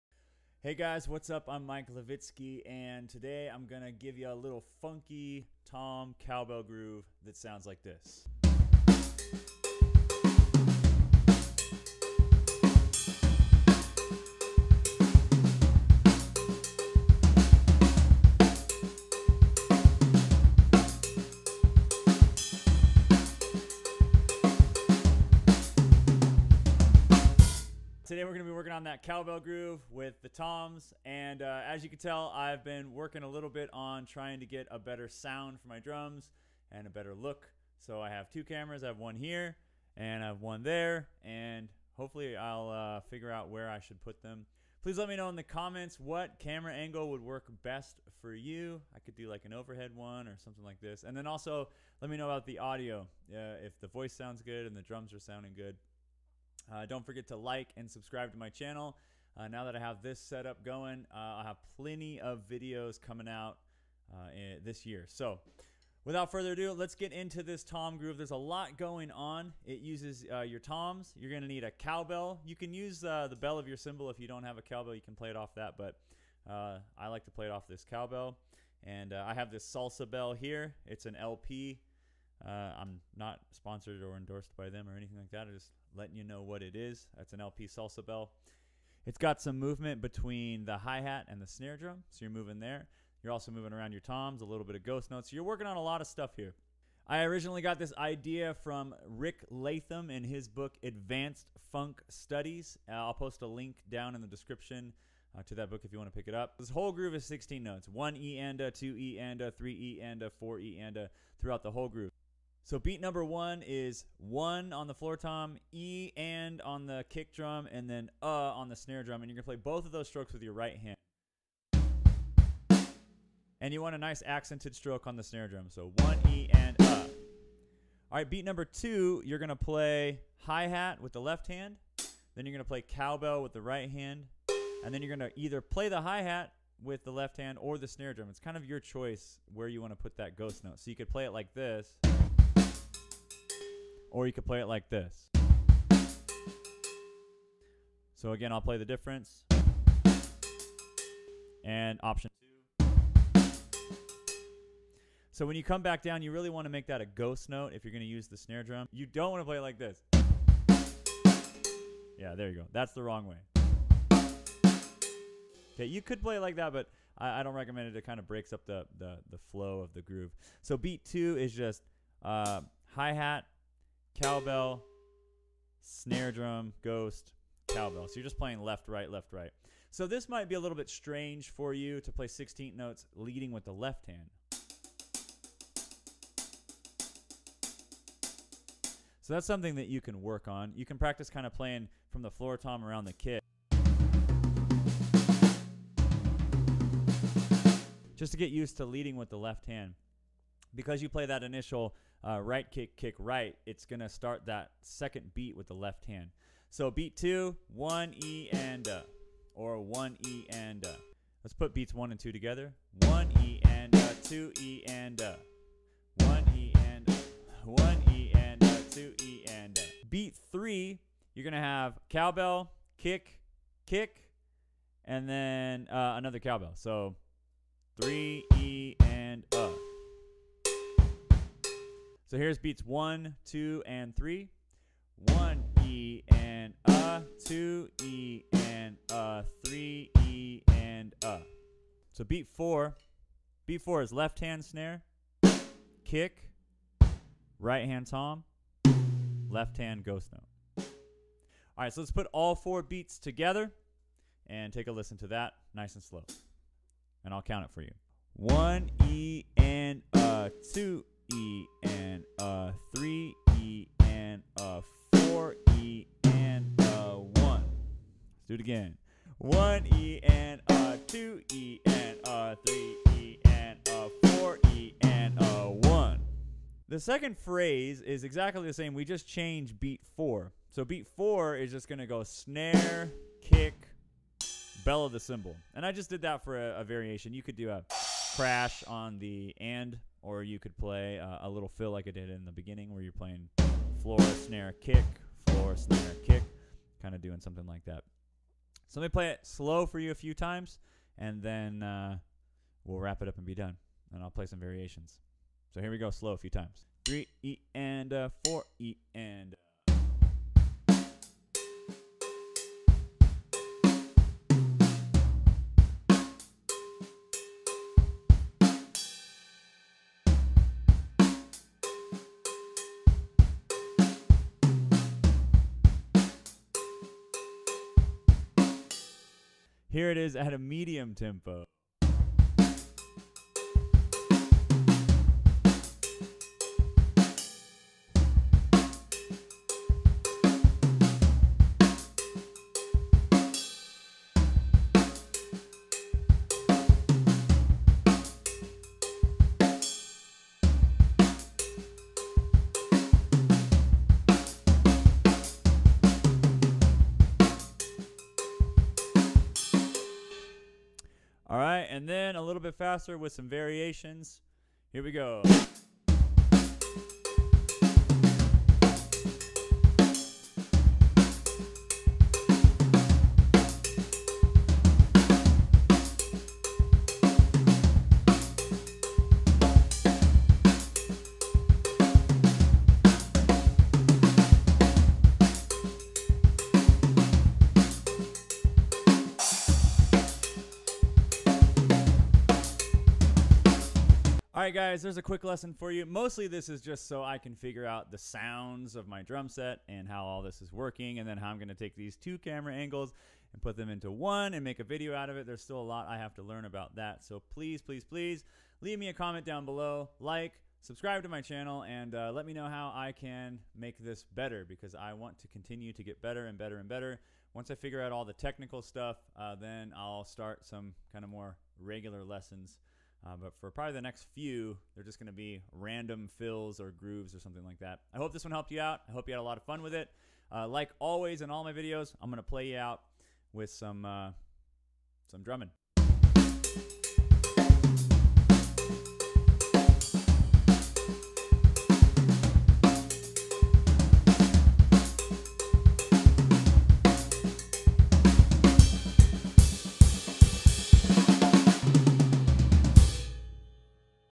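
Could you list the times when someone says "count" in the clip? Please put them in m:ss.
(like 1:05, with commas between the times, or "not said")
4:17.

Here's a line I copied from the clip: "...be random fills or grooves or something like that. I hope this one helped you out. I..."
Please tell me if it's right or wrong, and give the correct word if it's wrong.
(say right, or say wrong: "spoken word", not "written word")
right.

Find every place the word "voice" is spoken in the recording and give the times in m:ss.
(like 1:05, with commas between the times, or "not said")
0:53.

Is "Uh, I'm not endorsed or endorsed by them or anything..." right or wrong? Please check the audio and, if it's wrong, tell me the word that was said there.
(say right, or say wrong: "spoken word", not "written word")
wrong: "sponsored", not "endorsed".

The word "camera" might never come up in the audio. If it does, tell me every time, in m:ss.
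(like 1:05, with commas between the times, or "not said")
0:38, 0:46, 6:42.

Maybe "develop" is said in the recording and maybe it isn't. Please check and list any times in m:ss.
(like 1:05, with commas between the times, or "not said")
not said.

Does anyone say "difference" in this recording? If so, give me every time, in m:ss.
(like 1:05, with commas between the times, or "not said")
2:28.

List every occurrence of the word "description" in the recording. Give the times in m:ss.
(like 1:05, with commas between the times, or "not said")
1:44.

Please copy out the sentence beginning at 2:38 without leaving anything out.
You don't want to play it like this.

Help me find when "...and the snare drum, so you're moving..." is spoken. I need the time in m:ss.
1:31.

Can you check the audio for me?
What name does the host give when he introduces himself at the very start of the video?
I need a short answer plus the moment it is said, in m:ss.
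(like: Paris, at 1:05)
Mike Levitsky, at 0:01.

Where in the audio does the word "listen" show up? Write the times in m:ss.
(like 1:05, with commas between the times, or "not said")
4:14.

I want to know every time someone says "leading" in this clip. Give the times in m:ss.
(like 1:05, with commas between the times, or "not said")
3:03, 3:18.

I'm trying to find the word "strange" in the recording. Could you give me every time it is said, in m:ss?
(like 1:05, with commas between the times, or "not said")
3:00.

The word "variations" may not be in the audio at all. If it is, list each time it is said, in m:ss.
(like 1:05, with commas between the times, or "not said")
4:46, 5:04, 6:03.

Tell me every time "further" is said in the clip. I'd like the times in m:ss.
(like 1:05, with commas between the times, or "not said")
1:06.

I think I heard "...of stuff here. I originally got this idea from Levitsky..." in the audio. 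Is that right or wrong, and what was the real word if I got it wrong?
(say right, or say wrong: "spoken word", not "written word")
wrong: "Rick", not "Levitsky".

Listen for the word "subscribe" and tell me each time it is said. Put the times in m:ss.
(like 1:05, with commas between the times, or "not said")
0:57, 6:50.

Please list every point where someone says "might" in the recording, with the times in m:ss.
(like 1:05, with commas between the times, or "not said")
3:00.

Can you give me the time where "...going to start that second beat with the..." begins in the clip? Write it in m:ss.
3:23.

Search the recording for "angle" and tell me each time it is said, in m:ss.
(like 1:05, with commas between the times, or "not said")
0:46, 6:42.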